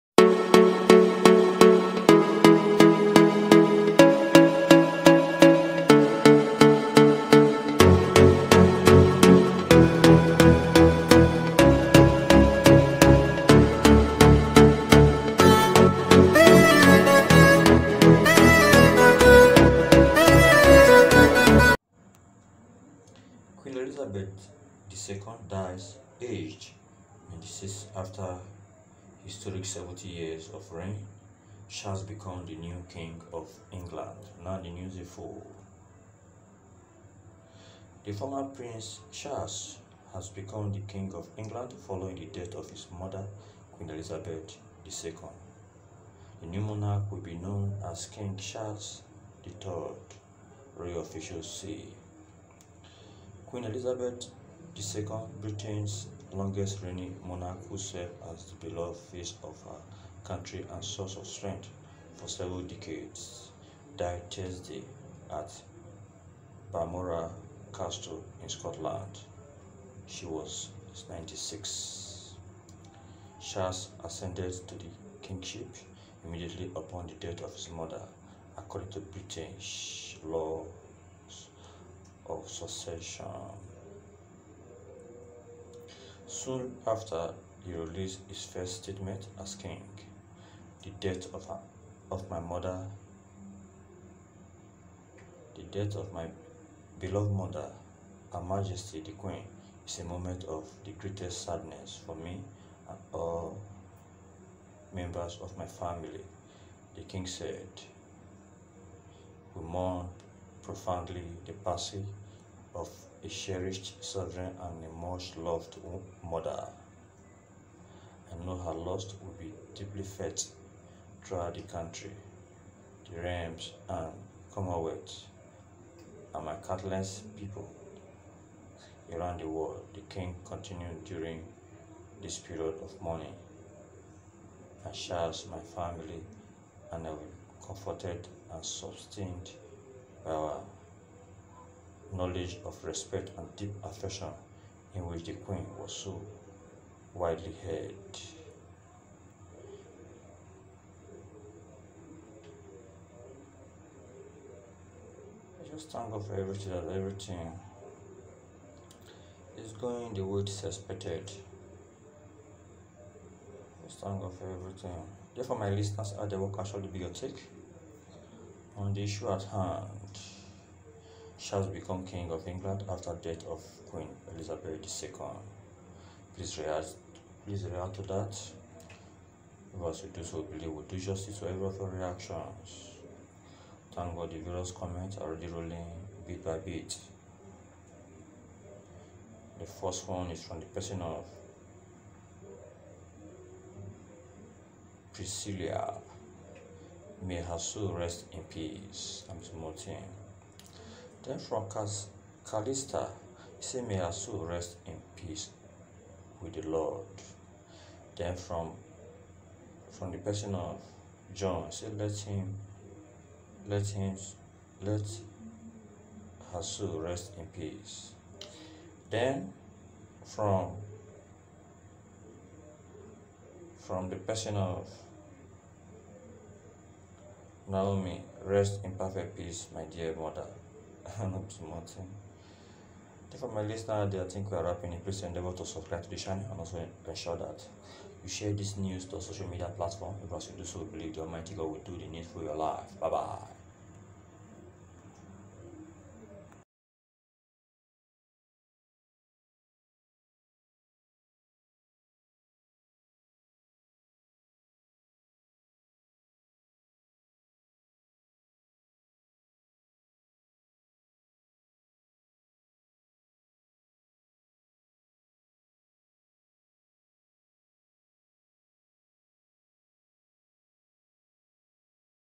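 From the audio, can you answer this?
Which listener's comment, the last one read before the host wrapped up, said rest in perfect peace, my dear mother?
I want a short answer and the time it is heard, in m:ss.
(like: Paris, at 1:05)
Naomi, at 3:47.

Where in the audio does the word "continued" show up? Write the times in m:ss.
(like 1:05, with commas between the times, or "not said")
2:10.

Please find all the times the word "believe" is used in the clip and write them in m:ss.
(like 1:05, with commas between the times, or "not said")
3:00, 4:00.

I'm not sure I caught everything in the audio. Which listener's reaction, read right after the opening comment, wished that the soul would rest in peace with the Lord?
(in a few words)
Calista.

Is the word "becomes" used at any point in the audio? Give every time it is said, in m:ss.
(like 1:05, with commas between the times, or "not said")
0:32, 0:40.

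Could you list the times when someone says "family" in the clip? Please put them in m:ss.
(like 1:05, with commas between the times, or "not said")
1:45, 2:15.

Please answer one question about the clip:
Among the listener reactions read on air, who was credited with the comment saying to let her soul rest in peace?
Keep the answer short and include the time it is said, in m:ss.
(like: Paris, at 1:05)
John, at 3:31.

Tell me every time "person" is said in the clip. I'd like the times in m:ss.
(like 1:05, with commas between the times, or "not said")
3:10, 3:30, 3:44.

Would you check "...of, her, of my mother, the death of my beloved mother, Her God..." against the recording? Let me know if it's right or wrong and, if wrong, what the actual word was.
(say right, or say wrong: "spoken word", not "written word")
wrong: "Majesty", not "God".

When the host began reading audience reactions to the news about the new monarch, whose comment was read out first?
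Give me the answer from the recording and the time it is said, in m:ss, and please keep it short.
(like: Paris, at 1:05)
Priscilla, at 3:15.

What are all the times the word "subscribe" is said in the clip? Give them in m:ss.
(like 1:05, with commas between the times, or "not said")
3:55.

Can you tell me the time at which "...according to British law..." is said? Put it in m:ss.
1:18.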